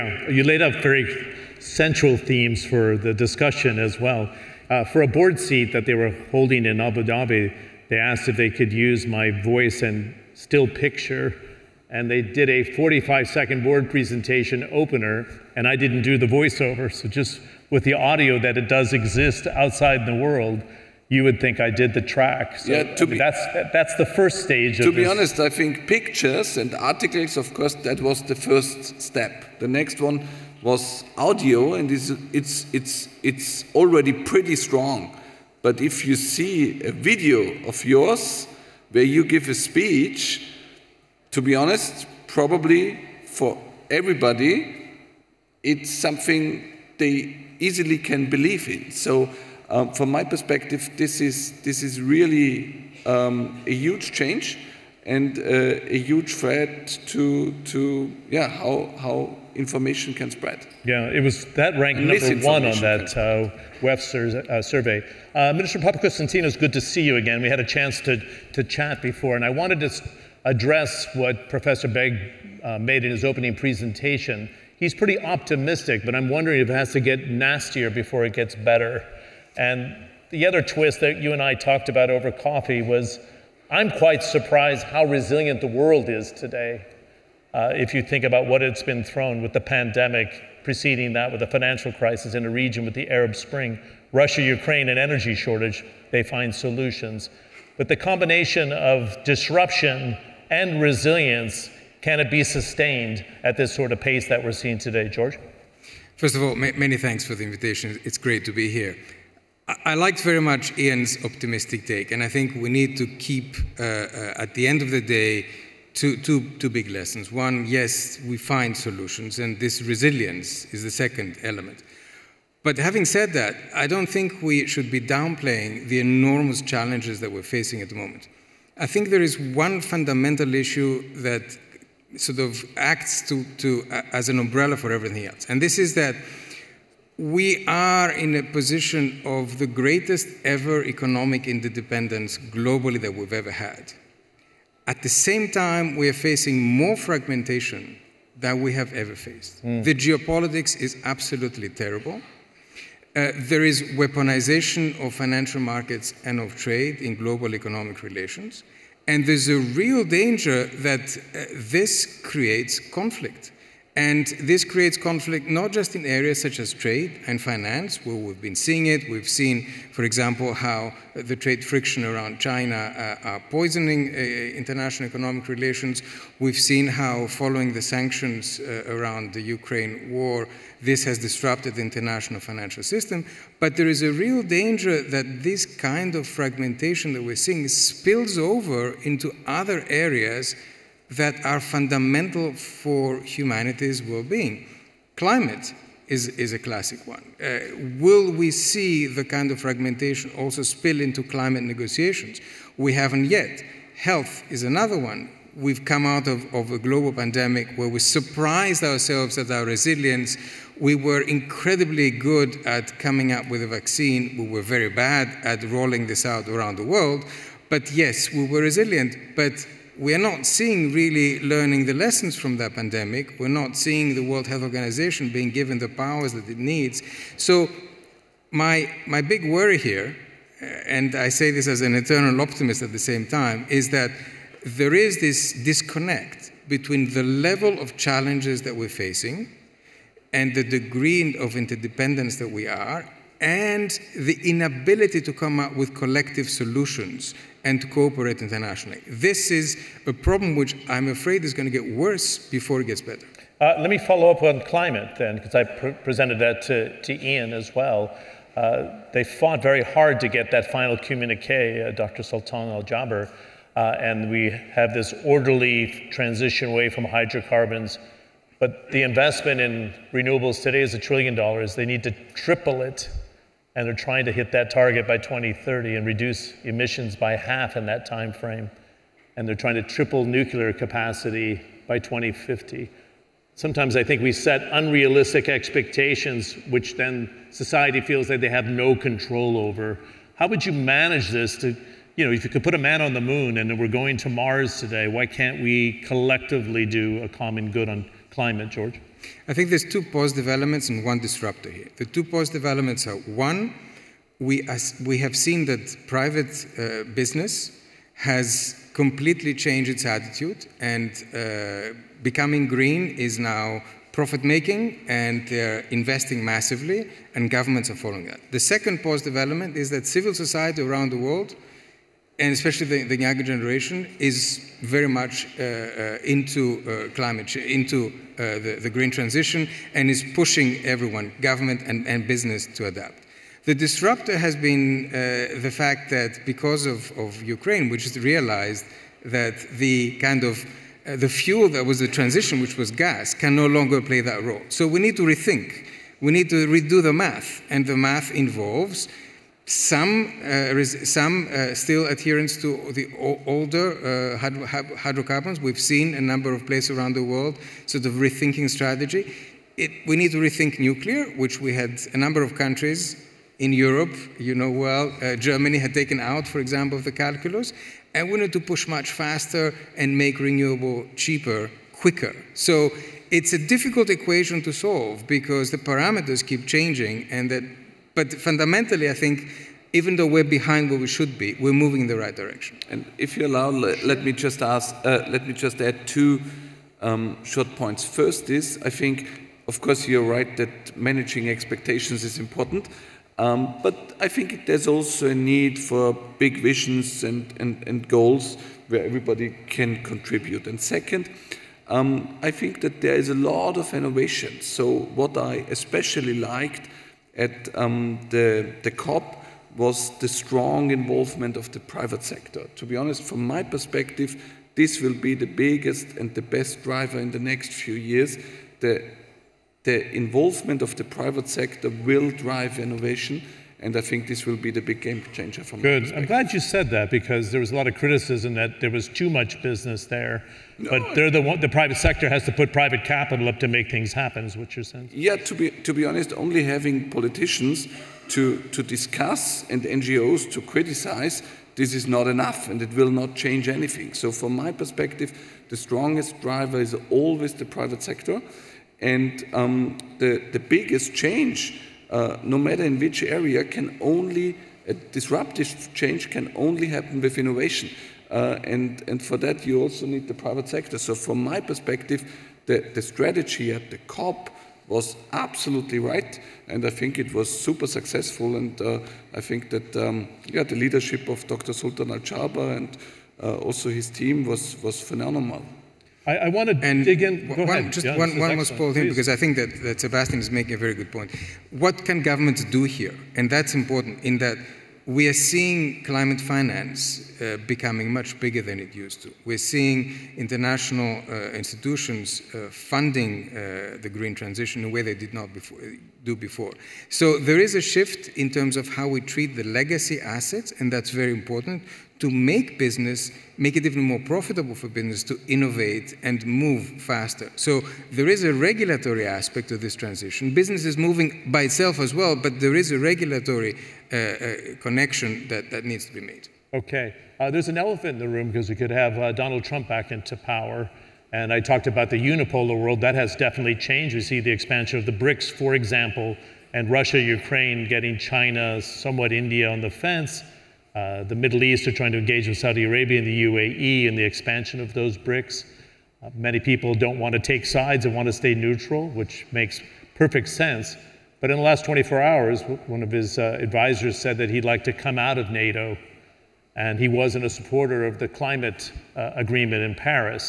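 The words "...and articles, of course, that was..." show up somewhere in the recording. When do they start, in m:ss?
0:26.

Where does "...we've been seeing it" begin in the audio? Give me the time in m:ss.
2:48.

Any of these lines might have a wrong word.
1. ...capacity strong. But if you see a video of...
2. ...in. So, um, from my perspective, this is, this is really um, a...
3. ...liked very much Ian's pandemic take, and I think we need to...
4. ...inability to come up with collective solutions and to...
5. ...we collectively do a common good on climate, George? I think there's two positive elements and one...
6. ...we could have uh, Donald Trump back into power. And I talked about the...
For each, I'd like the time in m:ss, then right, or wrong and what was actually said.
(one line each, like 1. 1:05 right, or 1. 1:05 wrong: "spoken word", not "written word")
1. 0:34 wrong: "pretty", not "capacity"
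2. 0:48 right
3. 1:49 wrong: "optimistic", not "pandemic"
4. 4:04 right
5. 4:55 right
6. 8:38 right.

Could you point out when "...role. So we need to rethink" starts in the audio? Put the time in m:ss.
5:44.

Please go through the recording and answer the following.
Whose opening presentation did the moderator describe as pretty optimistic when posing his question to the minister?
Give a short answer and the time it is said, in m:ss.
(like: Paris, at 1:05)
Professor Begg, at 1:11.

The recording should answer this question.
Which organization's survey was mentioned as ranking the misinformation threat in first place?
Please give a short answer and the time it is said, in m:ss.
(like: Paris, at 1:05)
WEF, at 1:03.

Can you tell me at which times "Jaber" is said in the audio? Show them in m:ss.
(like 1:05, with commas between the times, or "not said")
4:22, 7:52.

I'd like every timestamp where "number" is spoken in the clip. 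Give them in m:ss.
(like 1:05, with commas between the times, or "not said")
1:02, 5:56, 6:02.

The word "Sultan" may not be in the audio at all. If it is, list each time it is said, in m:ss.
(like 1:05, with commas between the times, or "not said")
4:22, 7:51.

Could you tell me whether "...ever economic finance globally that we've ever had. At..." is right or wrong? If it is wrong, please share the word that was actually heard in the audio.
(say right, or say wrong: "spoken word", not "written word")
wrong: "interdependence", not "finance".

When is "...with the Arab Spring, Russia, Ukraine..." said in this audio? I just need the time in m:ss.
1:32.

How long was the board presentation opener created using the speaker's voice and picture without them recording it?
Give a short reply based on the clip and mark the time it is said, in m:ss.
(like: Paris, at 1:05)
45 seconds, at 0:12.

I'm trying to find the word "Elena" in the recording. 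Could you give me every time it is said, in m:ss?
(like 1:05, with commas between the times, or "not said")
not said.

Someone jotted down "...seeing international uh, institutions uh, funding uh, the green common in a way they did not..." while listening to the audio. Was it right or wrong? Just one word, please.
wrong.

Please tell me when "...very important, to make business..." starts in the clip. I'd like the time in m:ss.
8:21.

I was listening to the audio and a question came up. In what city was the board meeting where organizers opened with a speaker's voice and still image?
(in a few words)
Abu Dhabi.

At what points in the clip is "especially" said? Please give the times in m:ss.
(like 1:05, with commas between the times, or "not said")
5:22, 6:45.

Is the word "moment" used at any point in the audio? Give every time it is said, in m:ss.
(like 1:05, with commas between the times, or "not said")
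2:07.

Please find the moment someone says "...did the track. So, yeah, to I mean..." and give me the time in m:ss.
0:21.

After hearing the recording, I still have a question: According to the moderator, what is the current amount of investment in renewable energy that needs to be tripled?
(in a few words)
A trillion dollars.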